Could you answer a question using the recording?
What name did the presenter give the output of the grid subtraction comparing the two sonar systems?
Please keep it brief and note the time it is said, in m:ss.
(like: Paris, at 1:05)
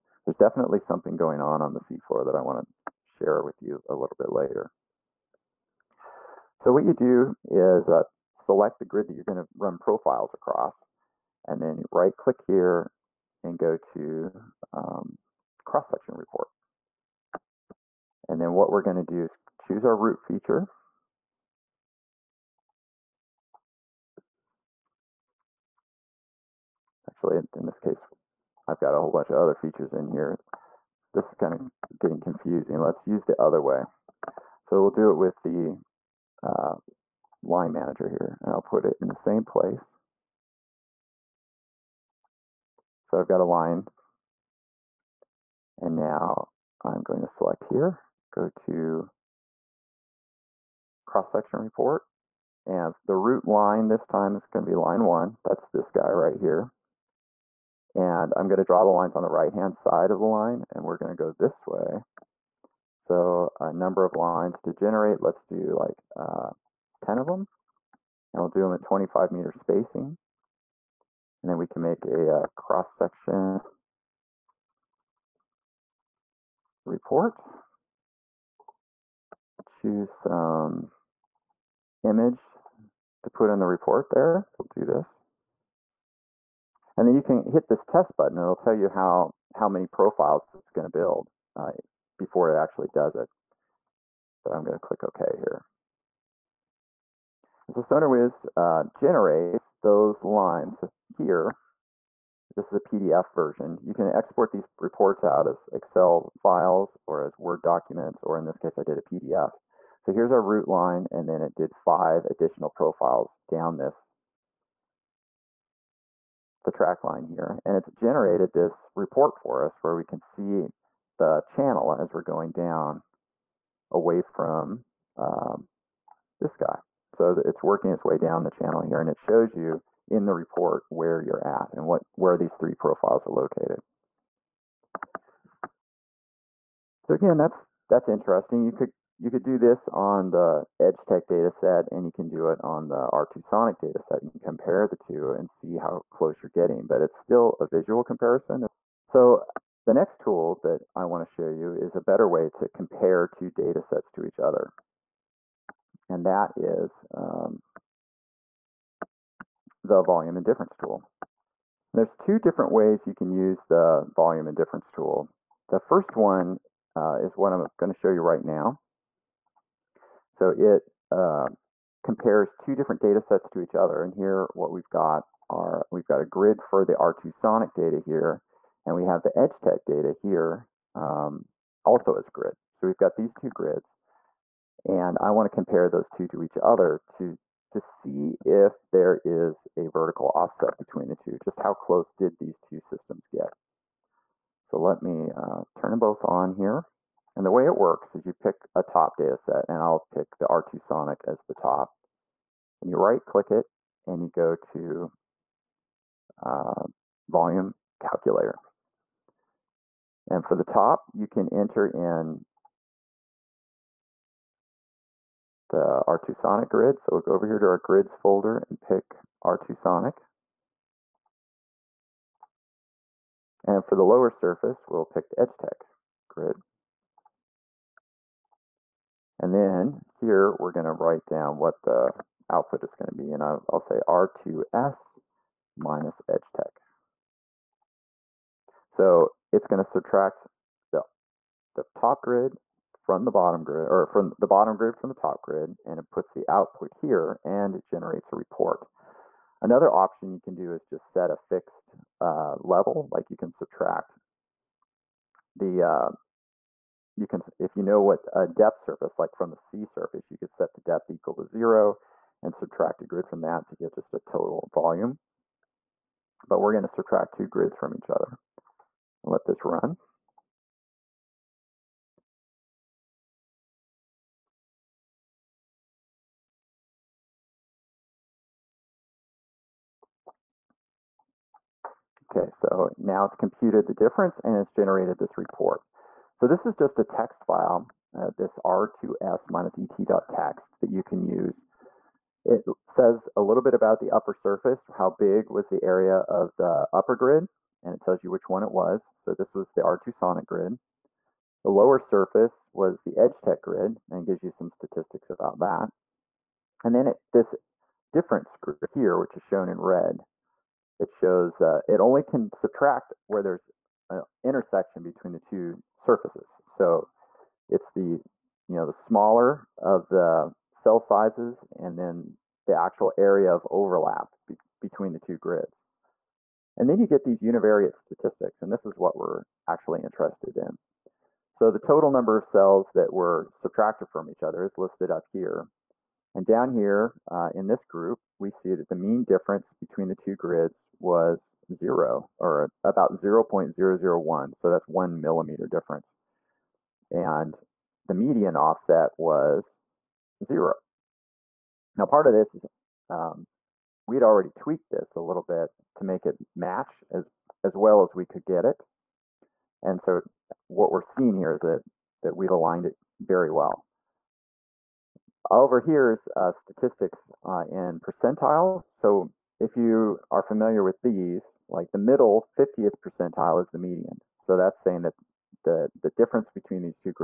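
R2S minus EdgeTech, at 3:54.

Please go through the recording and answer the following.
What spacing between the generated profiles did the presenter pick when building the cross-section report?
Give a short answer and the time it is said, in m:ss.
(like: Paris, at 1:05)
25 meters, at 1:08.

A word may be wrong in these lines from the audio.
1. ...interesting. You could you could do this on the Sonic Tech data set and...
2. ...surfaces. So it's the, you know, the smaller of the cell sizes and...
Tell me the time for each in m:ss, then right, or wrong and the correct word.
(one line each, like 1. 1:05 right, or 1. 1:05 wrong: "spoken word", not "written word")
1. 2:18 wrong: "Edge", not "Sonic"
2. 5:15 right.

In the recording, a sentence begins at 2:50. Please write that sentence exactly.
So it uh, compares two different data sets to each other.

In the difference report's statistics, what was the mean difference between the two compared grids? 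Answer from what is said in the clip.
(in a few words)
0.001.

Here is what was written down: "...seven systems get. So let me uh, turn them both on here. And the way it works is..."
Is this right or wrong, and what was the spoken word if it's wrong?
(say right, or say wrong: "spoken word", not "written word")
wrong: "two", not "seven".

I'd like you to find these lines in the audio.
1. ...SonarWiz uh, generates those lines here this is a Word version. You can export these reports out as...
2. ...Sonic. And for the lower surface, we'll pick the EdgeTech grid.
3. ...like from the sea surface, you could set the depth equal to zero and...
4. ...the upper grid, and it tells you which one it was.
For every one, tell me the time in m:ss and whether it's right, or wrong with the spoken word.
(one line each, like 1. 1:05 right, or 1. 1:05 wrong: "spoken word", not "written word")
1. 1:37 wrong: "PDF", not "Word"
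2. 3:39 right
3. 4:19 right
4. 4:56 right.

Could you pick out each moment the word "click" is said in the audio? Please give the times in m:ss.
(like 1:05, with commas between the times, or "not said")
0:12, 1:34, 3:23.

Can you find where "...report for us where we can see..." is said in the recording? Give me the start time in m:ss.
1:58.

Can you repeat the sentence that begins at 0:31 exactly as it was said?
This is kind of getting confusing.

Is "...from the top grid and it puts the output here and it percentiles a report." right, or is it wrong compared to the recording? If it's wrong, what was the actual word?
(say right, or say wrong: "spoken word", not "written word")
wrong: "generates", not "percentiles".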